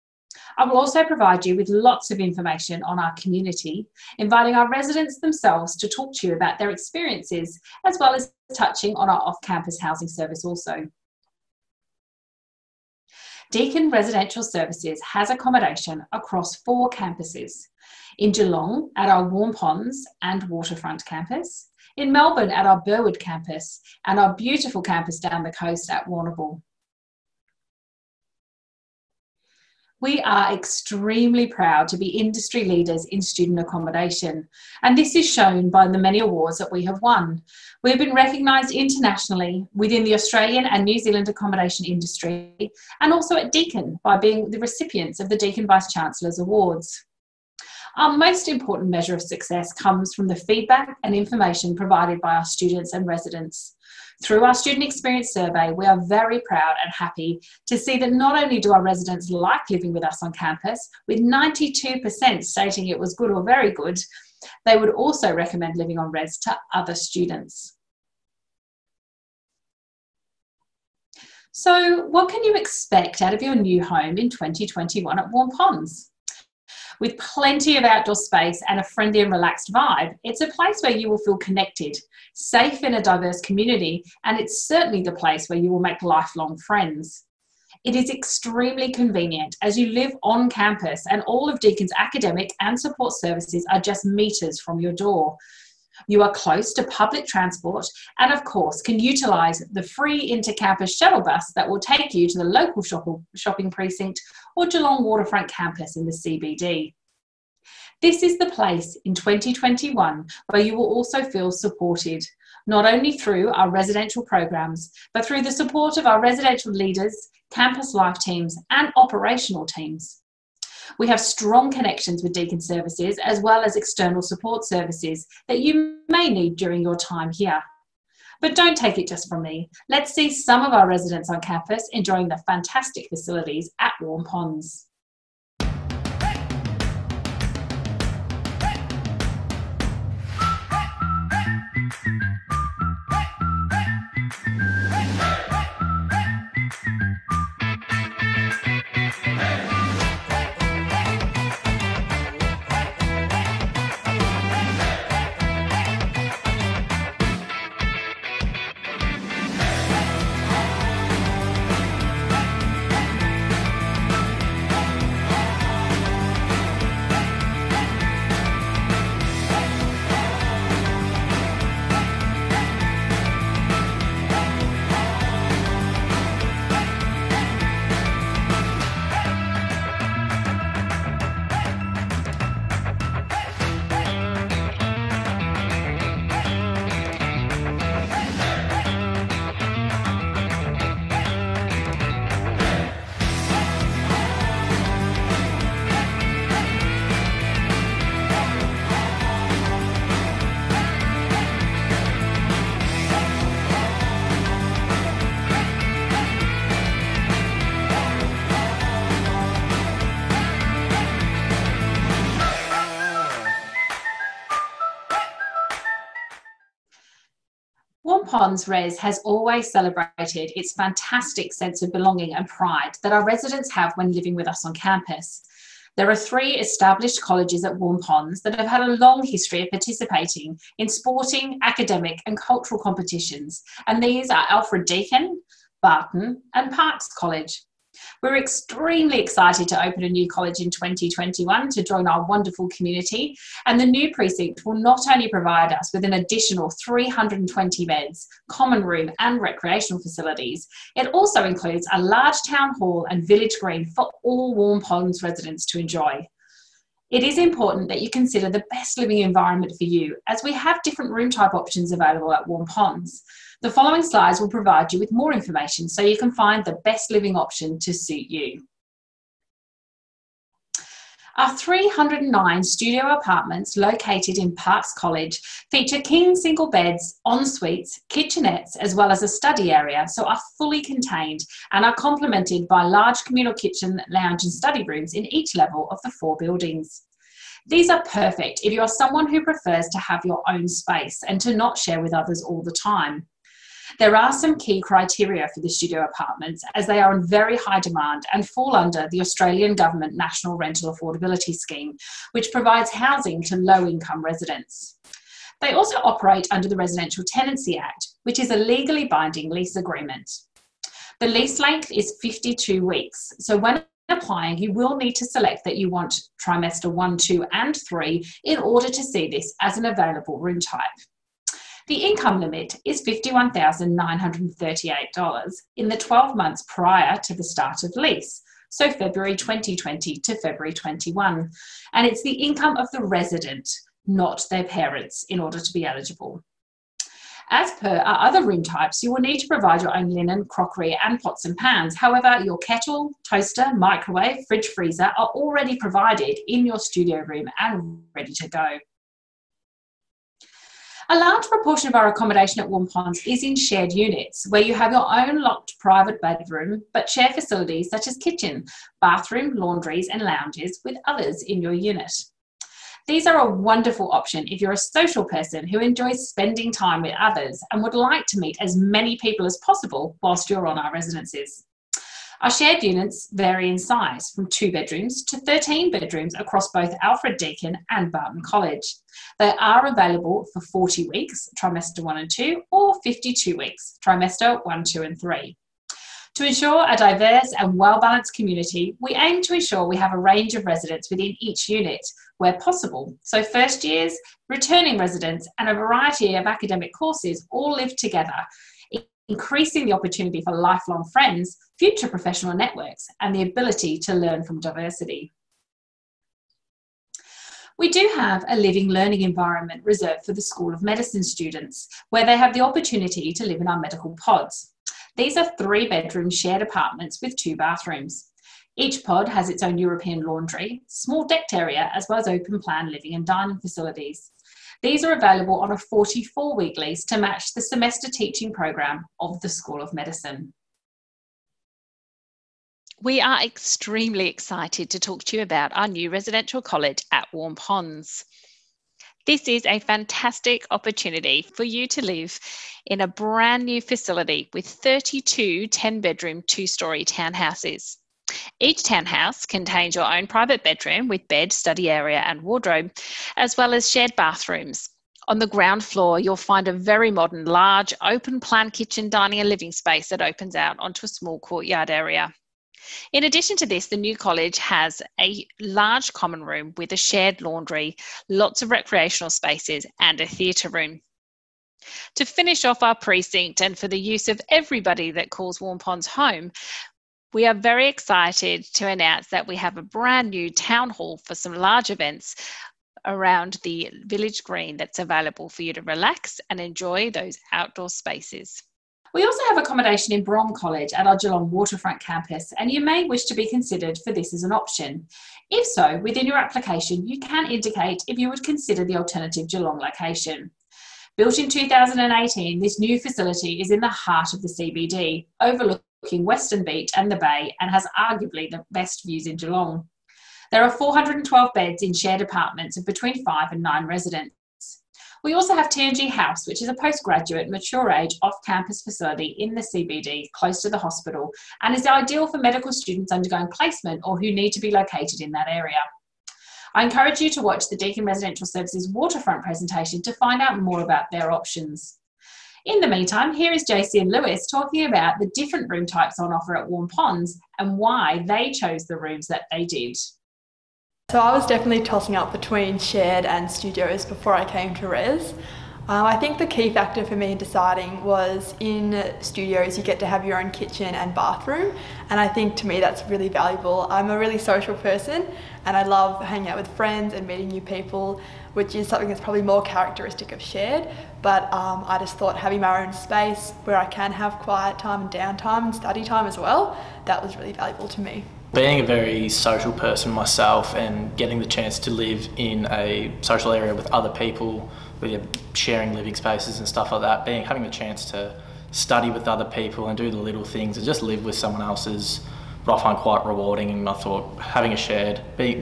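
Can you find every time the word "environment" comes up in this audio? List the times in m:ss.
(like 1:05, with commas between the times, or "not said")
4:19, 6:49.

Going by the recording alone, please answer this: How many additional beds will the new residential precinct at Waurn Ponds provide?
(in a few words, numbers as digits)
320.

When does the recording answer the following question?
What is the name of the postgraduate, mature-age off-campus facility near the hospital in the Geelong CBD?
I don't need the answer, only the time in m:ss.
8:35.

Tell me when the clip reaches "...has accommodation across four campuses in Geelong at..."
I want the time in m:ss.
0:15.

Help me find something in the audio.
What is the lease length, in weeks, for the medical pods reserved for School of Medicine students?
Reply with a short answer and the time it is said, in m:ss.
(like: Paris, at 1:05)
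44 weeks, at 7:05.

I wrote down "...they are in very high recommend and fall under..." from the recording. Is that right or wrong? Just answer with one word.
wrong.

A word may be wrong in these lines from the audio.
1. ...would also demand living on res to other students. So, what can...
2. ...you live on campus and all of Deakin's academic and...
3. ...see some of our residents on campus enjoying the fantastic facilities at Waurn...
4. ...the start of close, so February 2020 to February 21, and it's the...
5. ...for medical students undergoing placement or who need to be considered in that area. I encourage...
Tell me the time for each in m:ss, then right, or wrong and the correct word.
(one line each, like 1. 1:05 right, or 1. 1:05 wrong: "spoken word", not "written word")
1. 1:04 wrong: "recommend", not "demand"
2. 1:29 right
3. 2:10 right
4. 5:27 wrong: "lease", not "close"
5. 8:42 wrong: "located", not "considered".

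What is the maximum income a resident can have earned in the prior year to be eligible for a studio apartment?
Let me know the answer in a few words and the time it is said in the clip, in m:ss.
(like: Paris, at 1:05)
$51,938, at 5:23.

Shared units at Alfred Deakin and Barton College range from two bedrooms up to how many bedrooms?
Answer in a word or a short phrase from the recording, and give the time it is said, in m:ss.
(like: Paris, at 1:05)
13, at 6:15.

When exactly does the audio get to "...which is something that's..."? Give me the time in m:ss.
9:18.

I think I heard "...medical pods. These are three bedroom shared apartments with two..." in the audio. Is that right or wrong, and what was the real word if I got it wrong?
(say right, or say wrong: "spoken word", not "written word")
right.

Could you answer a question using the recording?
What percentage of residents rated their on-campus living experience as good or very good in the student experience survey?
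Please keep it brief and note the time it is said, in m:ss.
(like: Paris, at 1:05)
92%, at 1:01.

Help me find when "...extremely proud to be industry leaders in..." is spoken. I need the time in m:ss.
0:30.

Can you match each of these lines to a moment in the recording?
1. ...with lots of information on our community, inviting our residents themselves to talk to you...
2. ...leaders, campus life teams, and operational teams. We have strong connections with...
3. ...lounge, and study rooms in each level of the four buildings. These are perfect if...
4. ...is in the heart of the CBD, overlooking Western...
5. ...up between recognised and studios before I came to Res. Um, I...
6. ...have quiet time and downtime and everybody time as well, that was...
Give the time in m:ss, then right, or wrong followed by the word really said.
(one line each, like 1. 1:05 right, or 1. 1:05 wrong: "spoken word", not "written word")
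1. 0:01 right
2. 1:56 right
3. 4:44 right
4. 8:23 right
5. 9:02 wrong: "shared", not "recognised"
6. 9:24 wrong: "study", not "everybody".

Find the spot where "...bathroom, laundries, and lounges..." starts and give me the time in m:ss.
5:59.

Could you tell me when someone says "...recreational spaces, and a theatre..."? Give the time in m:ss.
7:48.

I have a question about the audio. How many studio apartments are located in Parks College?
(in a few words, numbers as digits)
309.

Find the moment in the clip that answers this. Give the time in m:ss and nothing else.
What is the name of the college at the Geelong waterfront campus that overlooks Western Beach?
8:10.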